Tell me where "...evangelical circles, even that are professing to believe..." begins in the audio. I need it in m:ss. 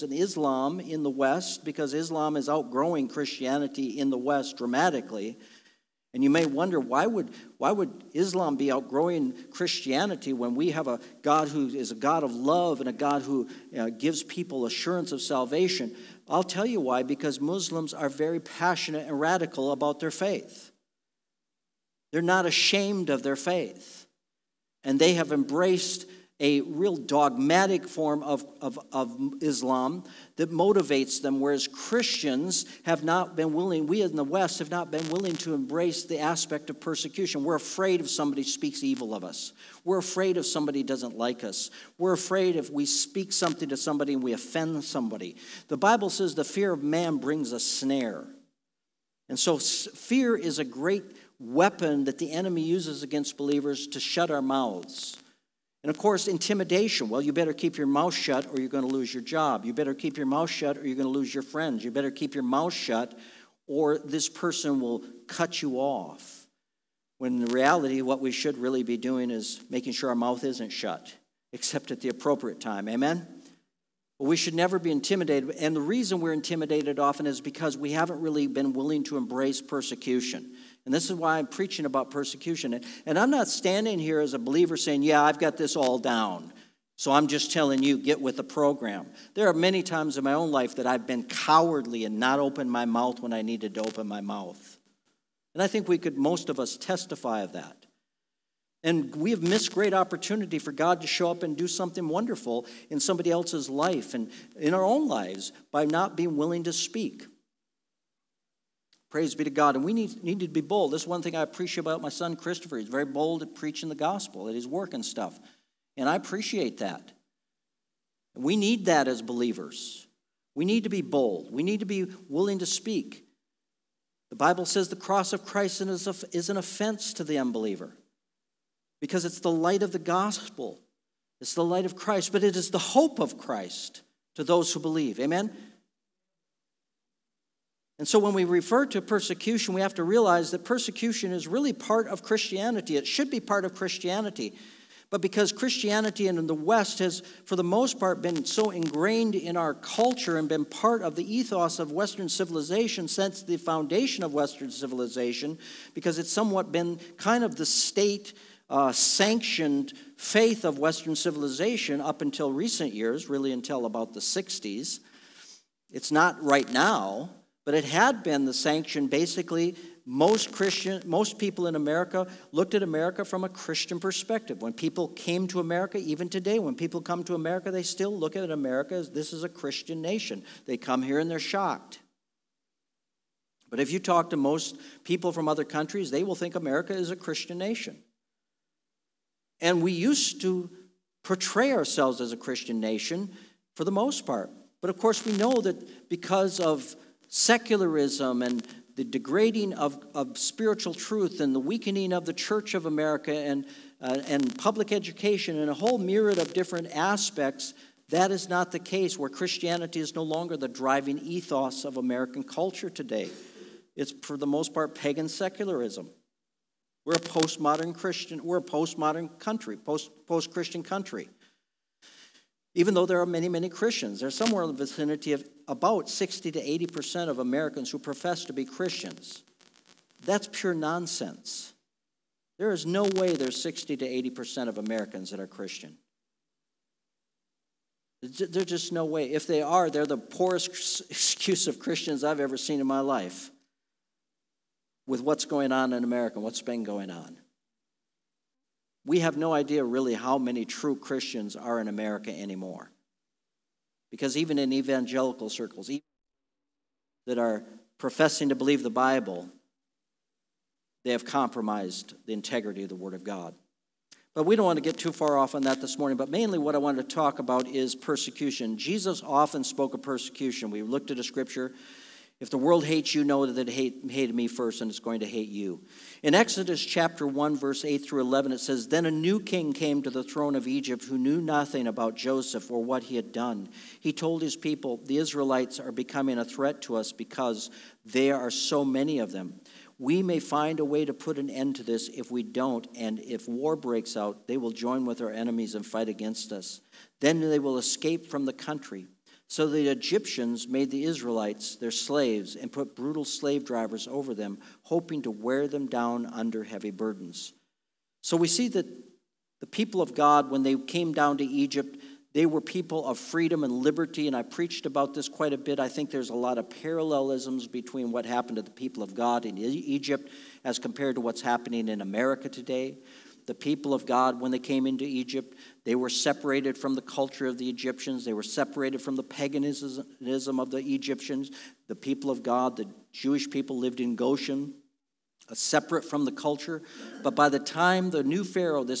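4:14.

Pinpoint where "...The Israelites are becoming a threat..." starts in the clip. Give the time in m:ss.
4:45.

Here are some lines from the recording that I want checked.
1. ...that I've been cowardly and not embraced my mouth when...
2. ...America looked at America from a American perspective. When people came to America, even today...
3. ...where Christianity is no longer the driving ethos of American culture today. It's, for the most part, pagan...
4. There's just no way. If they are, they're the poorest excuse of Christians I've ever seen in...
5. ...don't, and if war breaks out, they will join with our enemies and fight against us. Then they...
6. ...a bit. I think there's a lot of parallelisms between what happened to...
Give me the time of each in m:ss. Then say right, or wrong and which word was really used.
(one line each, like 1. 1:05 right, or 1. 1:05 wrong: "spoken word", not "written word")
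1. 1:30 wrong: "opened", not "embraced"
2. 2:51 wrong: "Christian", not "American"
3. 3:29 right
4. 3:58 right
5. 4:52 right
6. 5:15 right.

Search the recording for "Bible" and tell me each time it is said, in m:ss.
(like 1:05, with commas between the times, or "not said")
0:45, 2:04, 4:18.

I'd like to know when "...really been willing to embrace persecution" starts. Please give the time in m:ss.
1:18.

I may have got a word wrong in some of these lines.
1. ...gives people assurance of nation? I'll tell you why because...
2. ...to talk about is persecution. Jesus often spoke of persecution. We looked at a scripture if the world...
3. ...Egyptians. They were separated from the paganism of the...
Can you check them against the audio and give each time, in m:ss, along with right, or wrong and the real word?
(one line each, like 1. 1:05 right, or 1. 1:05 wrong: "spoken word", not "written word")
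1. 0:13 wrong: "salvation", not "nation"
2. 4:27 right
3. 5:27 right.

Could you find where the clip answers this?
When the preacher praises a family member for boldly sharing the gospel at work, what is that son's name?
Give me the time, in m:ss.
1:52.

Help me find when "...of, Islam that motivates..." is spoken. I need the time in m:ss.
0:28.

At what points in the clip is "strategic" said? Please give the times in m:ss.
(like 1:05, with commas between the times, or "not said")
not said.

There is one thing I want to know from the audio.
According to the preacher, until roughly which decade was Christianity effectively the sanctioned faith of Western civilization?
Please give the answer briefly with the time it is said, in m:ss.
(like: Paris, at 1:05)
the 60s, at 2:44.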